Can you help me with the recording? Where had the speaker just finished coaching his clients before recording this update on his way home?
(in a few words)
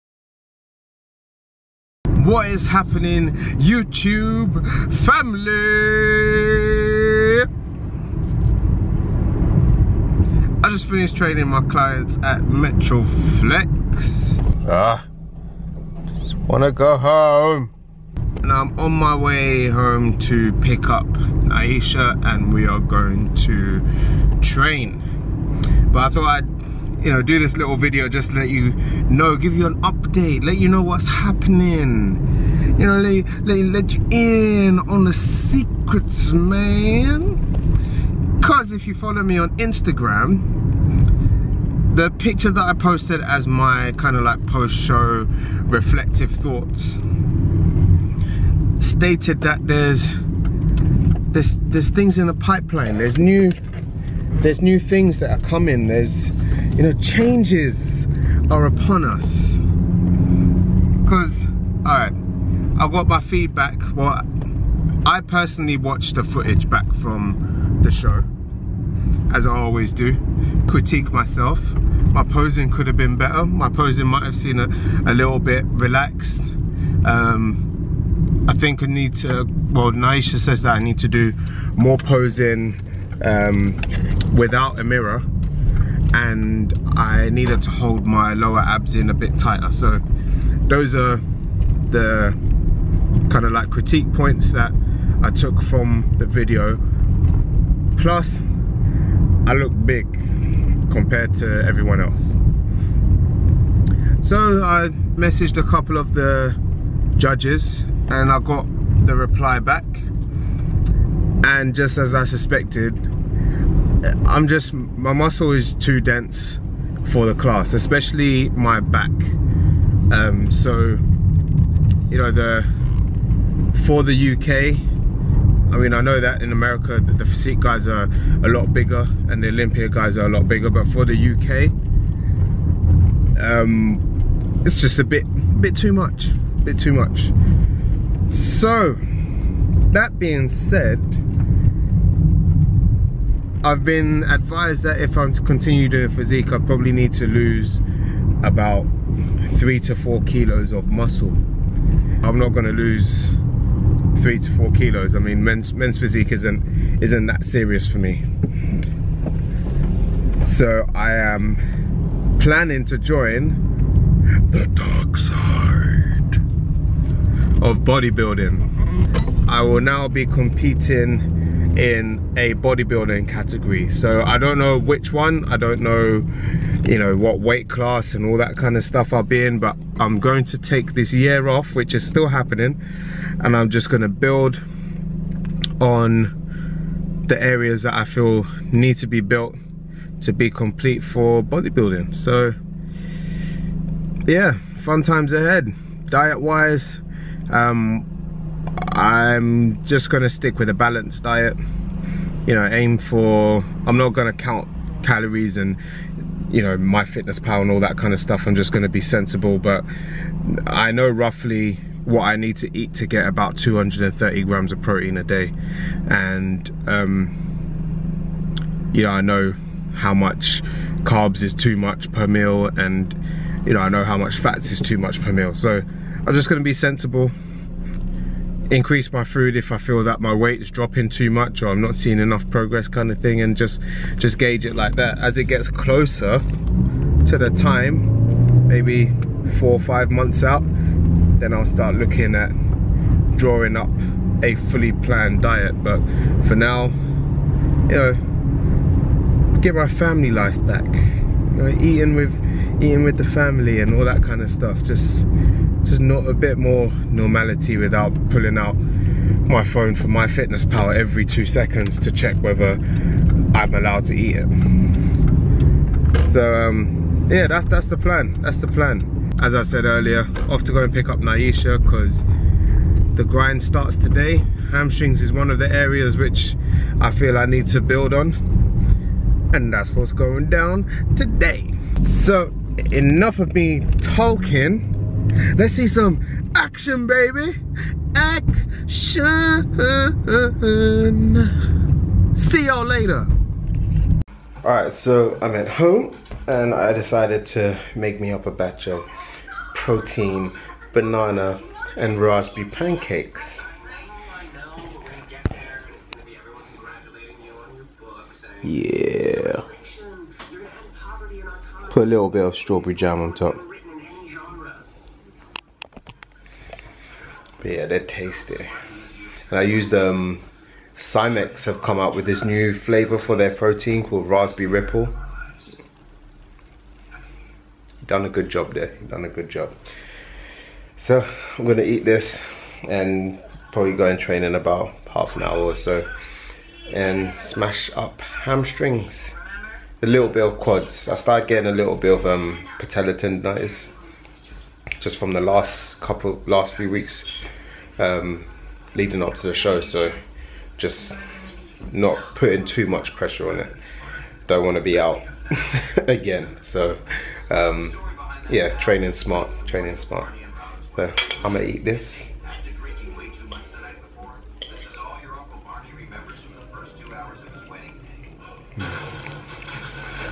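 Metroflex.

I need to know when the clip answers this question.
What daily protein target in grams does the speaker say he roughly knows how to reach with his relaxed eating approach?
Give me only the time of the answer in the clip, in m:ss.
3:33.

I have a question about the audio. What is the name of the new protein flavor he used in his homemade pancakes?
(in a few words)
Raspberry Ripple.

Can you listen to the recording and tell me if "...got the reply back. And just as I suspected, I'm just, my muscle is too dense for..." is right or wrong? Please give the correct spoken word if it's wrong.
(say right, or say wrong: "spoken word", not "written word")
right.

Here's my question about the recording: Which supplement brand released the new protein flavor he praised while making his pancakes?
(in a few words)
Sci-MX.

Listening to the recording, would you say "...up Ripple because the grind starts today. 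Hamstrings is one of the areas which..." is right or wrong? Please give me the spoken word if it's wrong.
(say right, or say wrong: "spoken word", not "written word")
wrong: "Nyisha", not "Ripple".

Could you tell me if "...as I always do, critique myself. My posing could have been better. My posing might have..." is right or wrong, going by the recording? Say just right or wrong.
right.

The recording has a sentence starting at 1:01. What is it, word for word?
Because, all right, I got my feedback.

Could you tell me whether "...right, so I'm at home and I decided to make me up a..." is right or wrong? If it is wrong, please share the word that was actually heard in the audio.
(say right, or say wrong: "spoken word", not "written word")
right.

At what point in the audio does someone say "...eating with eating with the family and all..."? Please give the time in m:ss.
4:11.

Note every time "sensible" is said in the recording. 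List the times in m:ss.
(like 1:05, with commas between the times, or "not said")
3:29, 3:46.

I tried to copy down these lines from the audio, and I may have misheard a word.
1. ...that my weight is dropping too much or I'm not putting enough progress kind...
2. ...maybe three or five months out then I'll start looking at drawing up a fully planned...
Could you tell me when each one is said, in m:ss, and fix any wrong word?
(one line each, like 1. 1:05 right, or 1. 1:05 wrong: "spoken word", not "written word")
1. 3:50 wrong: "seeing", not "putting"
2. 3:58 wrong: "four", not "three".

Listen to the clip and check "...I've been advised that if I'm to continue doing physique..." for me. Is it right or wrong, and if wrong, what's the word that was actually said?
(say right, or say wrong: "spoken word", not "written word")
right.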